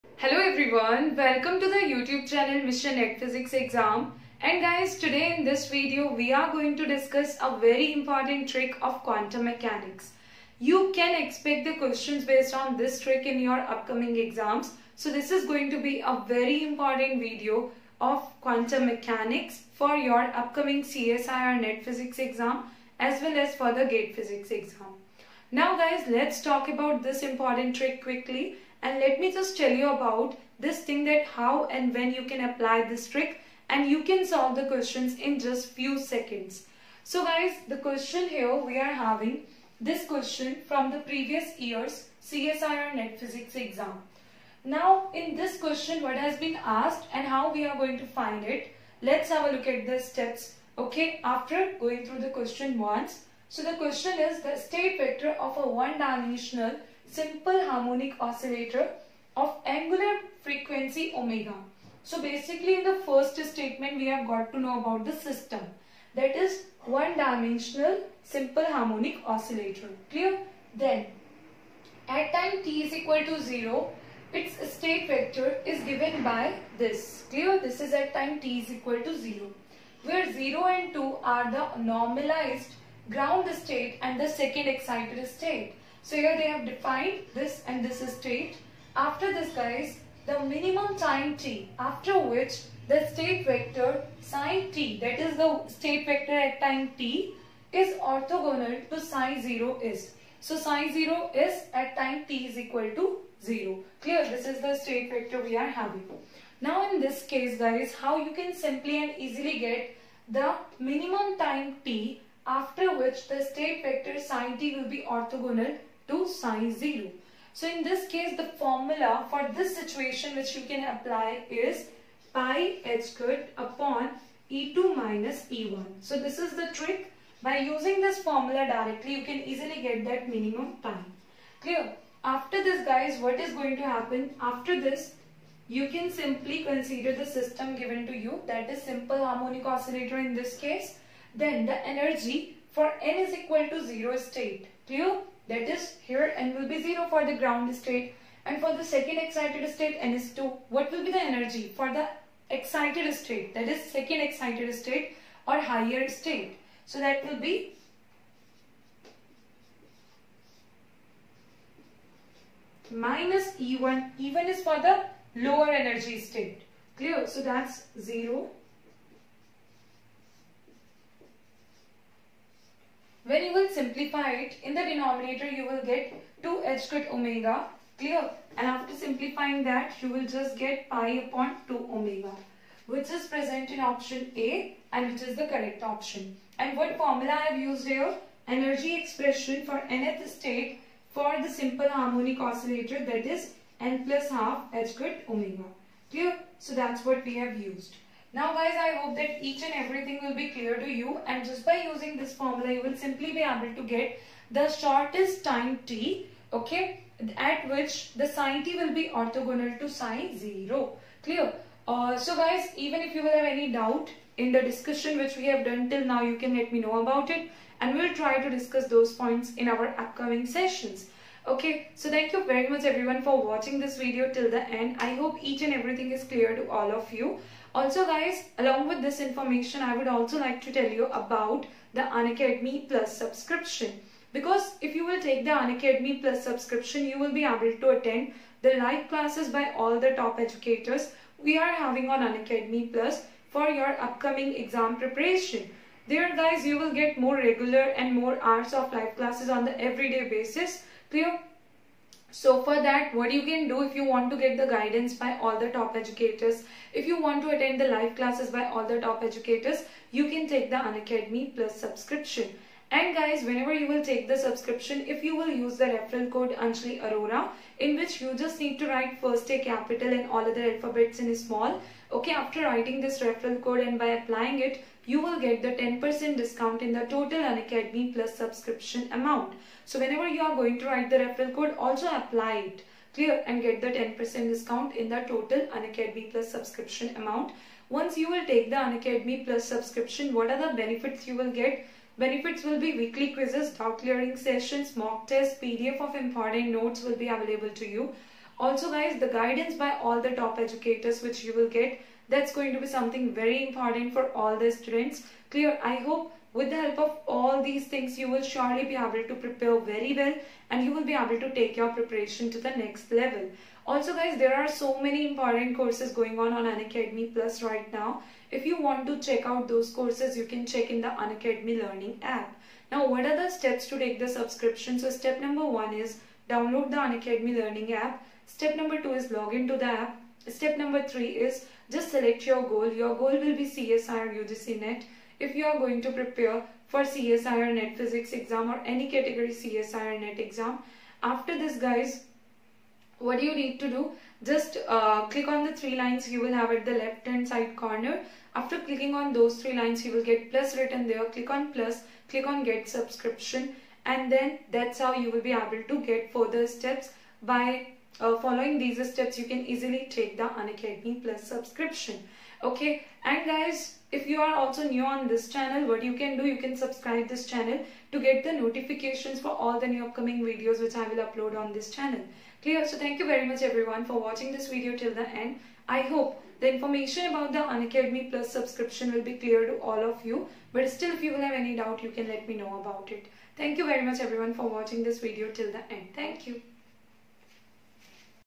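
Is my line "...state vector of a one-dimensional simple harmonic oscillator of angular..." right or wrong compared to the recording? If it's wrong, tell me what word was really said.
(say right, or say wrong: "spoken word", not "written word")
right.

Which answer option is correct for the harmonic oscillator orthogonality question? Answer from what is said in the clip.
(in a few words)
Option A.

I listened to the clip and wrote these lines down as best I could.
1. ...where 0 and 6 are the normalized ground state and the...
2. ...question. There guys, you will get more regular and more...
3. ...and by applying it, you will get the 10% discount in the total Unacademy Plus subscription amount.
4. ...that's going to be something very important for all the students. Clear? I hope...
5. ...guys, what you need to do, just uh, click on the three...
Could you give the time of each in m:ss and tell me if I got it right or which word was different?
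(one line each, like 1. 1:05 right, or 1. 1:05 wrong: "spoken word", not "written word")
1. 1:20 wrong: "2", not "6"
2. 4:04 wrong: "preparation", not "question"
3. 4:33 right
4. 5:02 right
5. 5:41 right.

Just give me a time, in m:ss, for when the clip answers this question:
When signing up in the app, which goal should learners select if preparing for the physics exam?
5:33.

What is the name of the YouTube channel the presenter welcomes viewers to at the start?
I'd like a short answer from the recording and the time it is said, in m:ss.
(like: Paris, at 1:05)
Mission NET Physics Exam, at 0:02.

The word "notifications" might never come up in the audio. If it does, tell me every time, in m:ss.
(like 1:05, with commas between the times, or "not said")
6:08.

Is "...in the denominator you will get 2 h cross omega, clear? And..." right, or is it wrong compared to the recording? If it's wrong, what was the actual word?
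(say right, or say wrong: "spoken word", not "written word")
right.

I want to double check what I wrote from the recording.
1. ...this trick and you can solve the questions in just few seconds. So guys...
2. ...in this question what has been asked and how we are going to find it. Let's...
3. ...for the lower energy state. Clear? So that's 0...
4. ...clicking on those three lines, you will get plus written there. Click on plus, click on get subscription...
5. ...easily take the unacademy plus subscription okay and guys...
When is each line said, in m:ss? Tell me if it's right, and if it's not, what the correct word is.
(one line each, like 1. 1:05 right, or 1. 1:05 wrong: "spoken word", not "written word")
1. 0:32 right
2. 0:45 right
3. 2:44 right
4. 5:48 right
5. 5:59 right.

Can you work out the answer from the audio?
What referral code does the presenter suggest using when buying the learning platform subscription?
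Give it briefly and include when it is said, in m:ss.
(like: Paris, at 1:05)
Anjali Arora, at 4:26.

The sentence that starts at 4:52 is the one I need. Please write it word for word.
Benefits will be weekly quizzes, thought clearing sessions, mock tests, PDF of important notes will be available to you.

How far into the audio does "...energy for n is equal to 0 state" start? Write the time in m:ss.
2:21.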